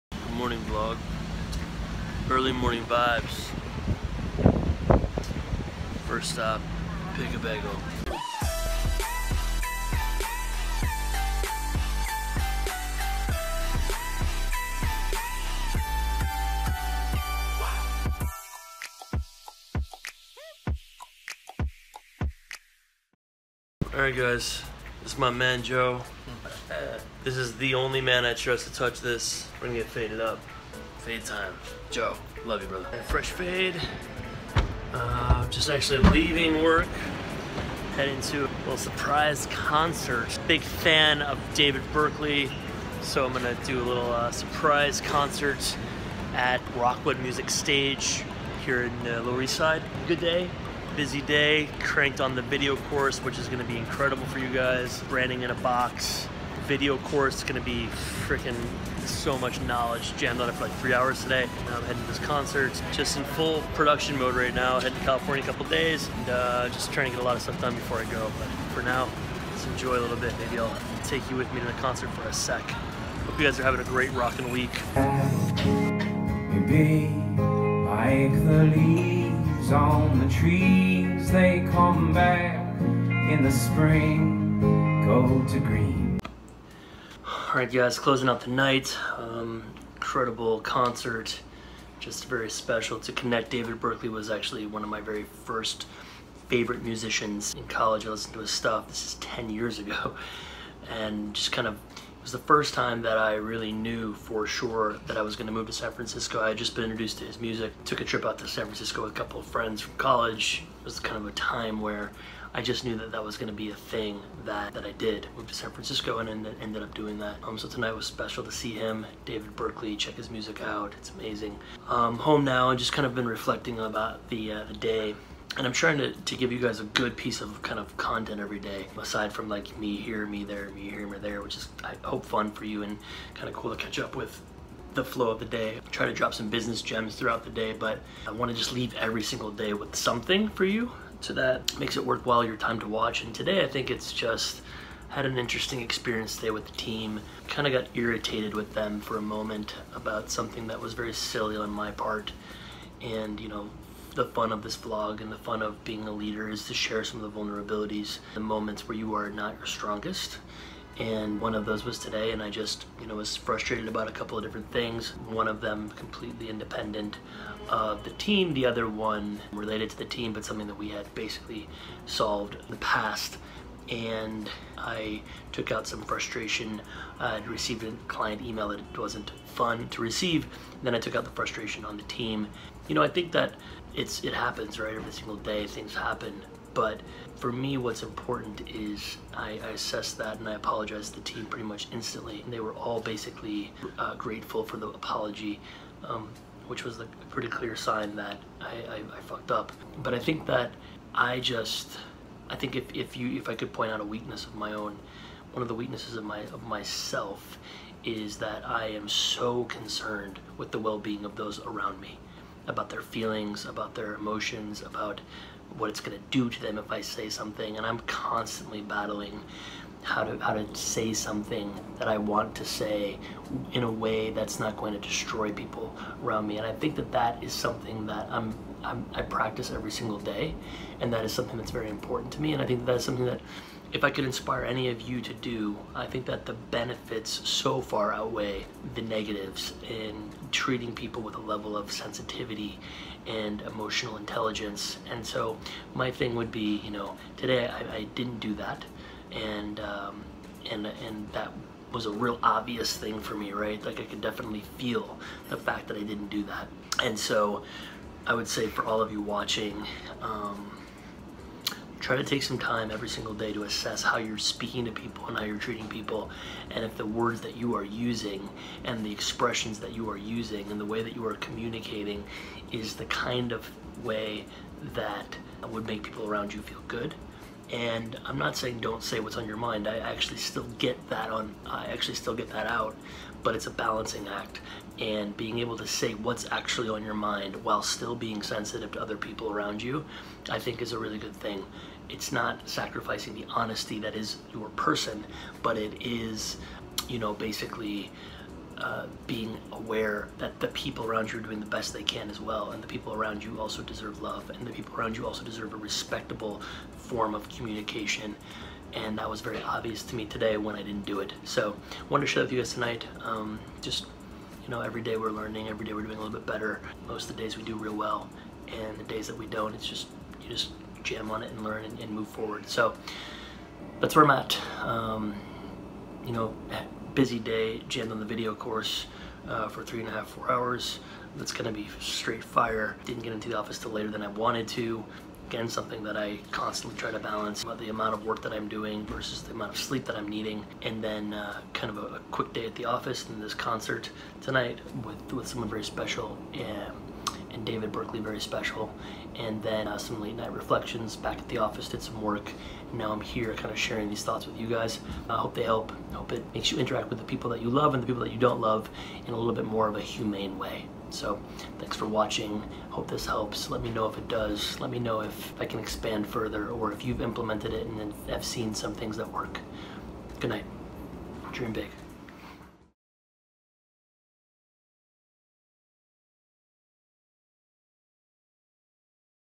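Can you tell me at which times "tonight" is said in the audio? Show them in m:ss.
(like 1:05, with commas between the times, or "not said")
1:57, 5:12, 5:44.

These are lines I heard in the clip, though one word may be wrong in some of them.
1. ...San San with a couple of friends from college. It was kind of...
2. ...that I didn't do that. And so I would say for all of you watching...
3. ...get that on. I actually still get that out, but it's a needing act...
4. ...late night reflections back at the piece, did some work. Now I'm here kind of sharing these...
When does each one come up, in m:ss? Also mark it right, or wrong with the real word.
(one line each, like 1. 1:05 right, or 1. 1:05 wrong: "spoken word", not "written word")
1. 1:48 wrong: "Francisco", not "San"
2. 4:15 right
3. 4:40 wrong: "balancing", not "needing"
4. 5:50 wrong: "office", not "piece".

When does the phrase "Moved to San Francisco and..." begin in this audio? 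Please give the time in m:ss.
1:55.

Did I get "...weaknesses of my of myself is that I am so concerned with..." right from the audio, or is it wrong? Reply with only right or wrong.
right.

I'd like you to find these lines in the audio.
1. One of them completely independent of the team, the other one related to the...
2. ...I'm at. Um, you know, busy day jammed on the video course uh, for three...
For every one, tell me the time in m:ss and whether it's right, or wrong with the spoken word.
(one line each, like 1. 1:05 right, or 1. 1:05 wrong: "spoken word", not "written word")
1. 2:45 right
2. 5:24 right.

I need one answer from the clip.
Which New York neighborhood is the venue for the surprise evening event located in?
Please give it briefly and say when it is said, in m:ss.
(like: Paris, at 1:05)
Lower East Side, at 0:49.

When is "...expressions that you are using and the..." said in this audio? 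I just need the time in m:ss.
4:29.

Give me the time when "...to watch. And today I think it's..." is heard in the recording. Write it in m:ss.
2:22.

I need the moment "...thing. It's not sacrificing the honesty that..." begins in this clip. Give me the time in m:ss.
4:51.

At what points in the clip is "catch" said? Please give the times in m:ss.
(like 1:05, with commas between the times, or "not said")
2:13.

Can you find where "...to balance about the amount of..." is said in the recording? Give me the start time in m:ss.
5:37.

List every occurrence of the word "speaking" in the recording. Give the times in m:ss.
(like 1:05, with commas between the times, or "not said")
4:24.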